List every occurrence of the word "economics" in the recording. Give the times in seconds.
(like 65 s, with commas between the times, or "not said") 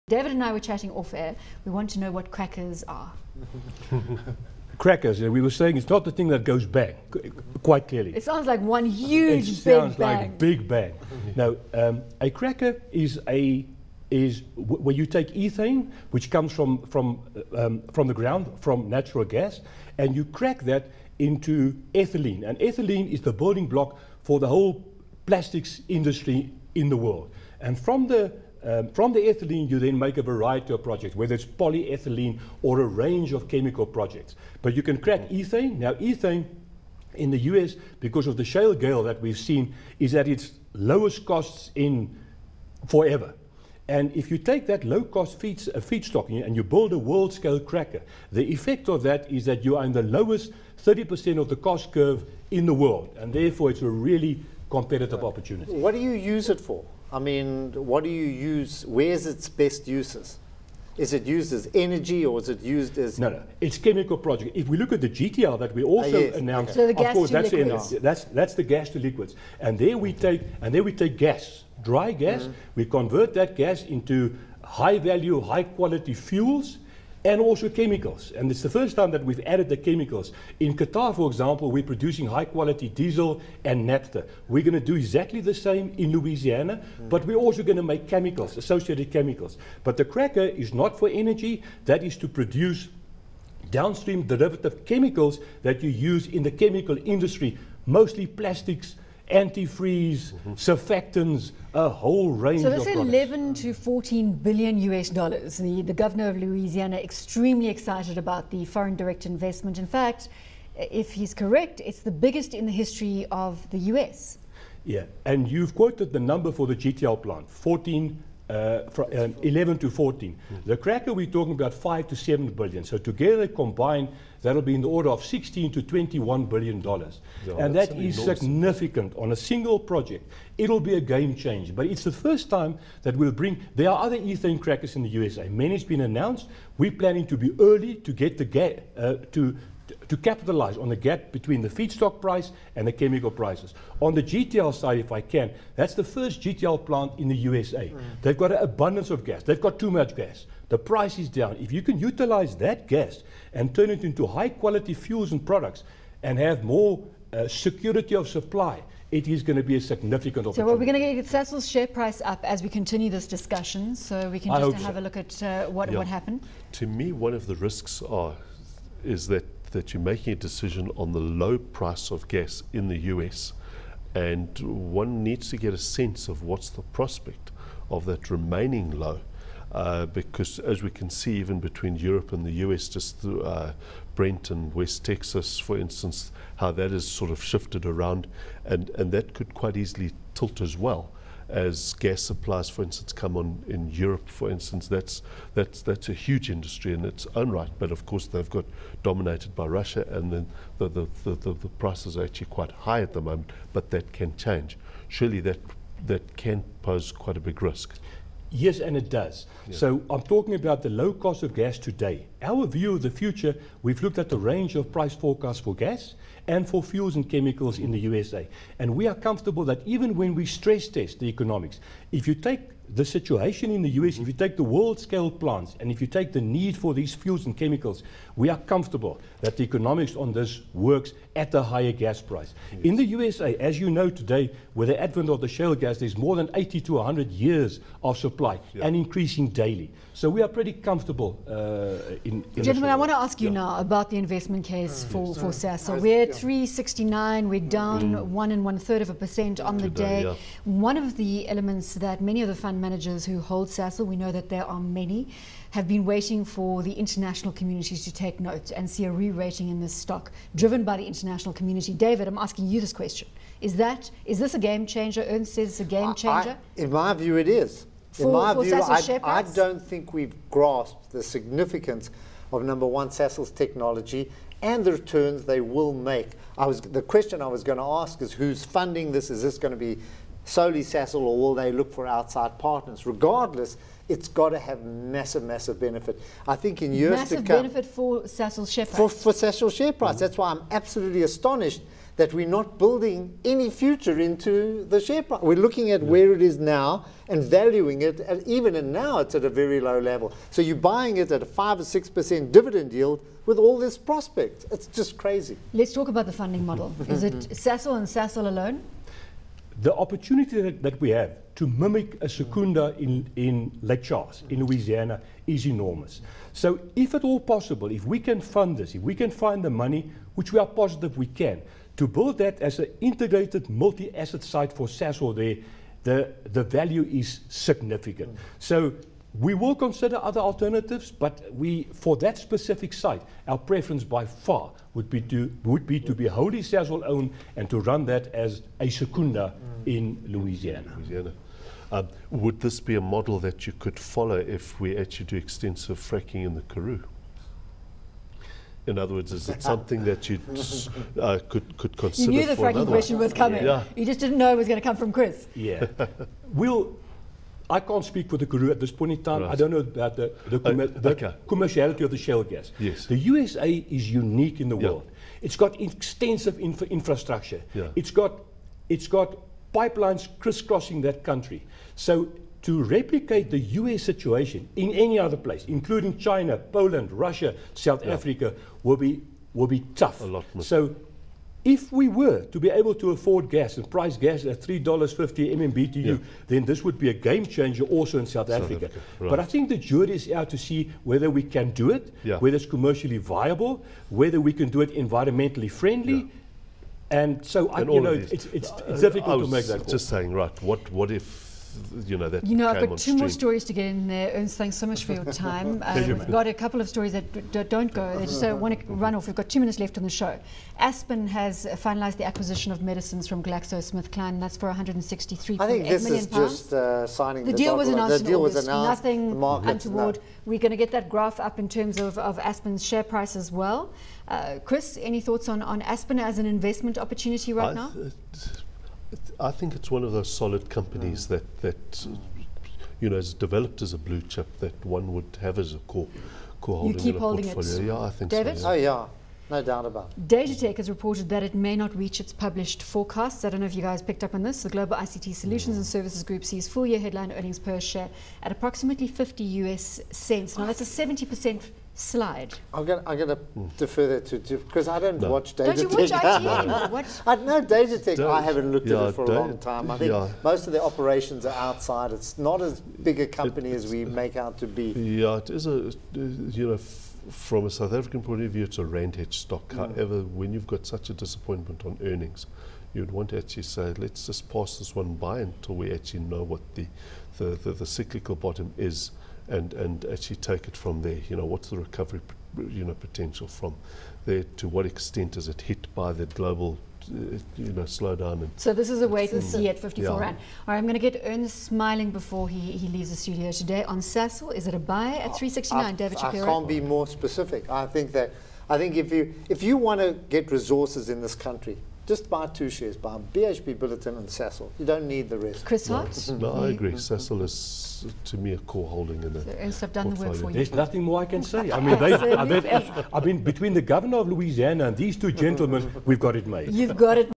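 221 s, 229 s.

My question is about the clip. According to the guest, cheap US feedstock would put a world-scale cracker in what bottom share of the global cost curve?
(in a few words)
30%.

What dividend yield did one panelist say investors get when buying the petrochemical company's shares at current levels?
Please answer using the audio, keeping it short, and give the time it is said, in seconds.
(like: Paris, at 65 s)
5 or 6%, at 301 s.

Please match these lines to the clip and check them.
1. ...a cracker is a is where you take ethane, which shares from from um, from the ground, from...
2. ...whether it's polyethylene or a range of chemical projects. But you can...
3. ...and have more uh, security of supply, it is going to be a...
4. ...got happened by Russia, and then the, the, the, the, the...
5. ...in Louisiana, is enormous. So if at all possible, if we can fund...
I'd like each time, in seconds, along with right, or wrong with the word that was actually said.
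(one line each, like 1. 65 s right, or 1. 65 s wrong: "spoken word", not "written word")
1. 12 s wrong: "comes", not "shares"
2. 31 s right
3. 156 s right
4. 198 s wrong: "dominated", not "happened"
5. 314 s right.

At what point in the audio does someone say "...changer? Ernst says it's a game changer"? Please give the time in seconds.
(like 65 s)
264 s.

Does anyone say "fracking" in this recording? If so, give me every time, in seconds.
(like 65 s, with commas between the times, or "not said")
345 s, 352 s.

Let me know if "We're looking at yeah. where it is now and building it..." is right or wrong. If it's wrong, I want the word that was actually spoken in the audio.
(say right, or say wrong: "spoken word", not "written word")
wrong: "valuing", not "building".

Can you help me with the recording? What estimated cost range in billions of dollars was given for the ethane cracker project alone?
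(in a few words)
5 to 7 billion.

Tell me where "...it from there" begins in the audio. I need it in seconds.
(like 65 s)
480 s.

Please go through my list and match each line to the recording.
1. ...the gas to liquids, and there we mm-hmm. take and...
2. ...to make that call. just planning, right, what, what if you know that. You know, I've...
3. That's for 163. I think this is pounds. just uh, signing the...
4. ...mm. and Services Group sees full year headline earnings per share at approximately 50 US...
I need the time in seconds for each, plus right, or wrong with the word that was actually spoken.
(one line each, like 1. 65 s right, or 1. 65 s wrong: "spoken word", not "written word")
1. 68 s right
2. 399 s wrong: "saying", not "planning"
3. 414 s right
4. 445 s right.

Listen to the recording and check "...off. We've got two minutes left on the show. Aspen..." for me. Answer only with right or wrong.
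right.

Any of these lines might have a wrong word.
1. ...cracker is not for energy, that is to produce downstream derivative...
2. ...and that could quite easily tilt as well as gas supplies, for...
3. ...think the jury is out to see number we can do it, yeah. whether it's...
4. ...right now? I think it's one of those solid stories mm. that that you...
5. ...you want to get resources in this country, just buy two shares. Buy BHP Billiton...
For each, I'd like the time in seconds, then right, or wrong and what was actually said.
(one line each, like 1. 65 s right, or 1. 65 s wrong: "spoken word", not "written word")
1. 90 s right
2. 188 s right
3. 389 s wrong: "whether", not "number"
4. 427 s wrong: "companies", not "stories"
5. 499 s right.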